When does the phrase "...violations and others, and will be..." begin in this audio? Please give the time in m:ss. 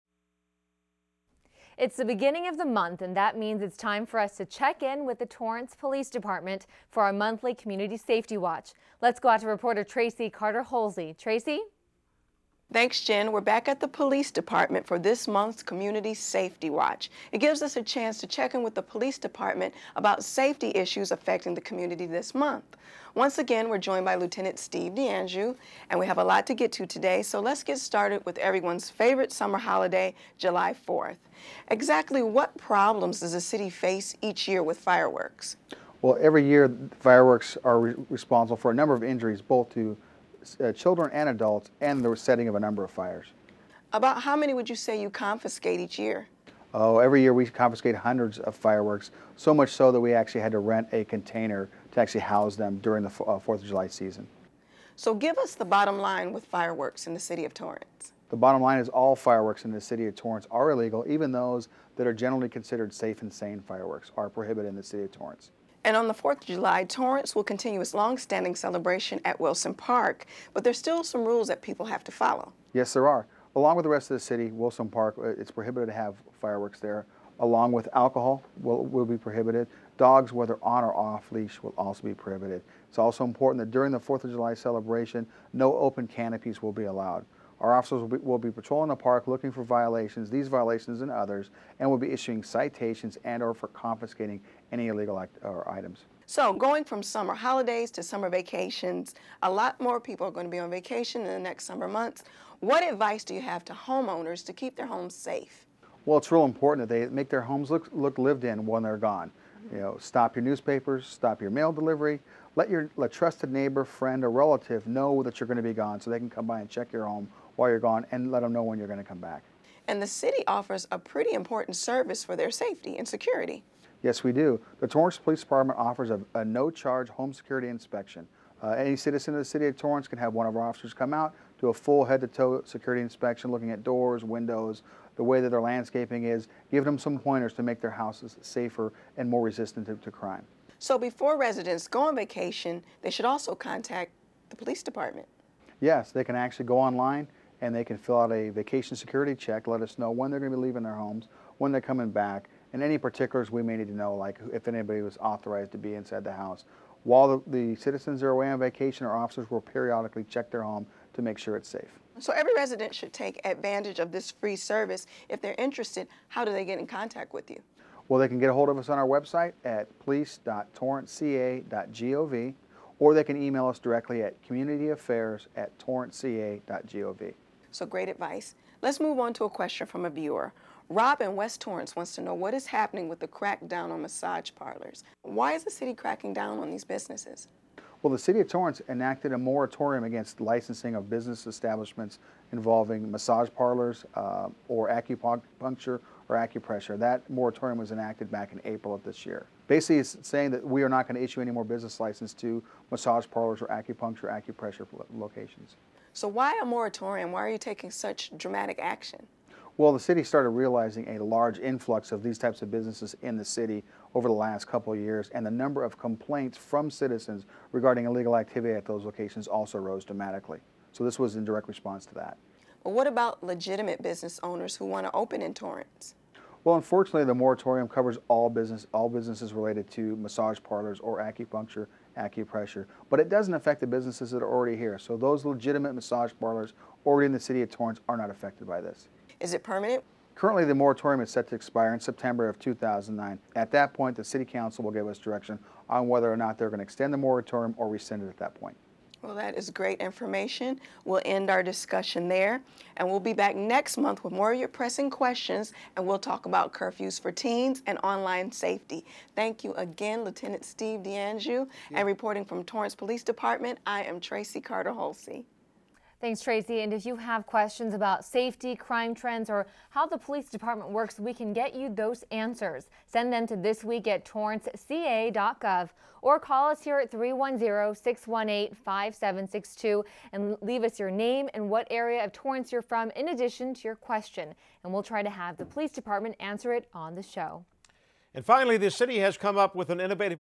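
1:30.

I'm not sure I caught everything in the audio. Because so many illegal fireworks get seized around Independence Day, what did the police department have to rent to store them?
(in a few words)
a container.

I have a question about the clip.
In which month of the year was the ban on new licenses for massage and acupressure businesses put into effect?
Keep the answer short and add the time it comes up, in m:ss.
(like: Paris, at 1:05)
April, at 3:18.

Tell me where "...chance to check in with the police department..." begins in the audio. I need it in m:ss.
0:17.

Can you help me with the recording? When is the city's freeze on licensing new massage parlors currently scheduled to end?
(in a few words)
September 2009.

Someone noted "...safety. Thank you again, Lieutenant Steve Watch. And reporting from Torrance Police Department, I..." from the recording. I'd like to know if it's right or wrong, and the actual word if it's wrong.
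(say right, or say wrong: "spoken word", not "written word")
wrong: "DeAnjou", not "Watch".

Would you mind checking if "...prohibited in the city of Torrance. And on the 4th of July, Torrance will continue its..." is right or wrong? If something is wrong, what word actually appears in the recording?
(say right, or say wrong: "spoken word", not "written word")
right.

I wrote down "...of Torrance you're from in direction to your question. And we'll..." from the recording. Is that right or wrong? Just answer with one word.
wrong.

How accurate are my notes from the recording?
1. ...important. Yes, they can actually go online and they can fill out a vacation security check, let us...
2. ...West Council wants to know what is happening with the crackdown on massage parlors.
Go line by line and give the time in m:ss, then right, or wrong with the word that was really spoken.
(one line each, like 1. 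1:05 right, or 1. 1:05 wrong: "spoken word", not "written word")
1. 2:24 wrong: "department", not "important"
2. 3:01 wrong: "Torrance", not "Council".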